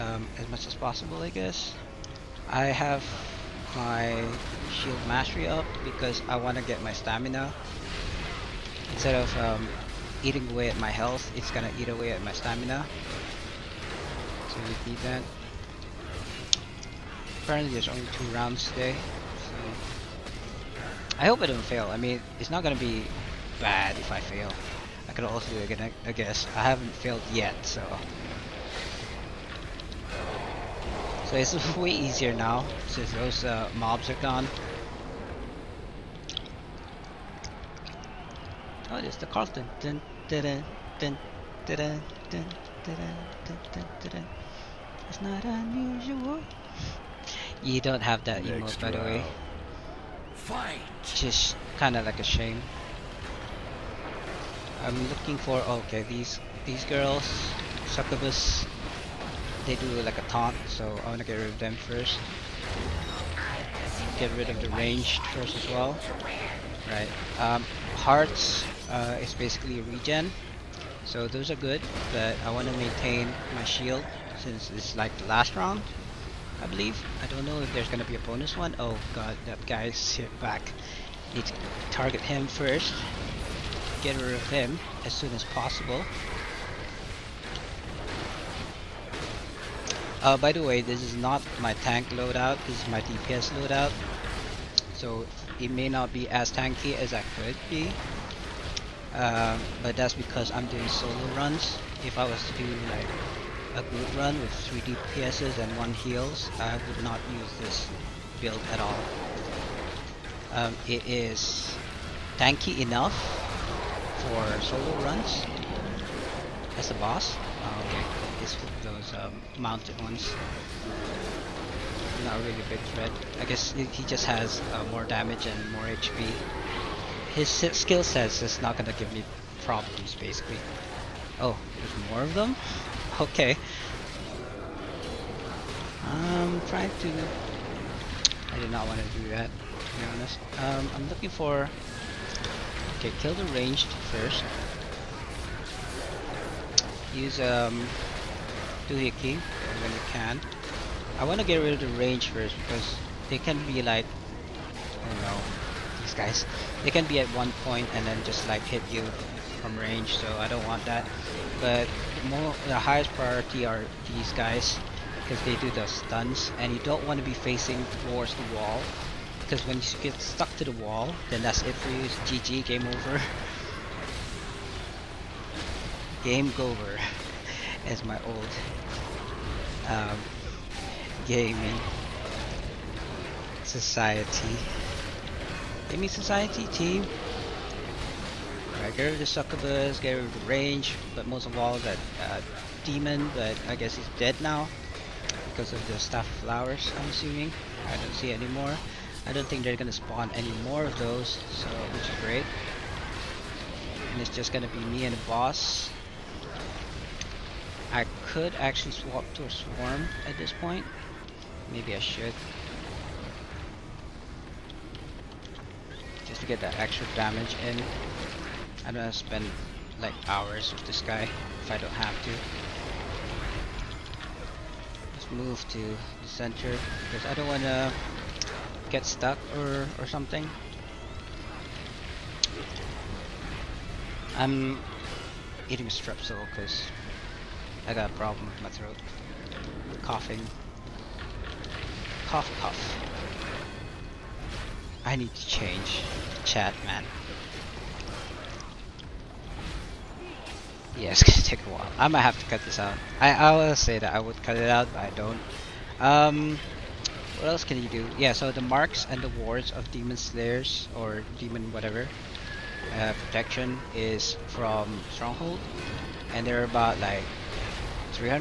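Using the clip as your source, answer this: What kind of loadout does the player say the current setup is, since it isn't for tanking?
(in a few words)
DPS loadout.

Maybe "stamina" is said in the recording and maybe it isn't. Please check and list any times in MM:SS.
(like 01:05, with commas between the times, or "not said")
00:06, 00:12.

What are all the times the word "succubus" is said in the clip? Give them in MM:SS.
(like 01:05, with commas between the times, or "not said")
00:57, 03:09.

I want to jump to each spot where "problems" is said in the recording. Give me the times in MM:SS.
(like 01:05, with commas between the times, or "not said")
02:09, 03:58.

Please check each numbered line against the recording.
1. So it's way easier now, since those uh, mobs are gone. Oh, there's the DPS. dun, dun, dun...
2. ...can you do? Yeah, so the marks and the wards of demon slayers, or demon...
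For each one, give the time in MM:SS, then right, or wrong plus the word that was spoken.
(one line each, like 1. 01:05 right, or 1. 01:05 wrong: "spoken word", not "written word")
1. 00:31 wrong: "Carlton", not "DPS"
2. 04:17 right.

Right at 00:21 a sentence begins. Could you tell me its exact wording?
I mean, it's not gonna be bad if I fail.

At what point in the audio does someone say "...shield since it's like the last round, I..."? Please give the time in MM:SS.
01:13.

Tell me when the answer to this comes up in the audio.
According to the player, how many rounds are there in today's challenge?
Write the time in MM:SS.
00:18.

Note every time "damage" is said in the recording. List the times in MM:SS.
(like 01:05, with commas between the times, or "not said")
02:05, 03:37.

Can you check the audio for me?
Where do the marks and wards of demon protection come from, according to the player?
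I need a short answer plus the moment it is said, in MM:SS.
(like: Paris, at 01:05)
Stronghold, at 04:25.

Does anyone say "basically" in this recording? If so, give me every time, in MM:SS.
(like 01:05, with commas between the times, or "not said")
01:09, 02:10.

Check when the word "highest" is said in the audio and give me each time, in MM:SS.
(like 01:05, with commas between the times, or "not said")
02:42.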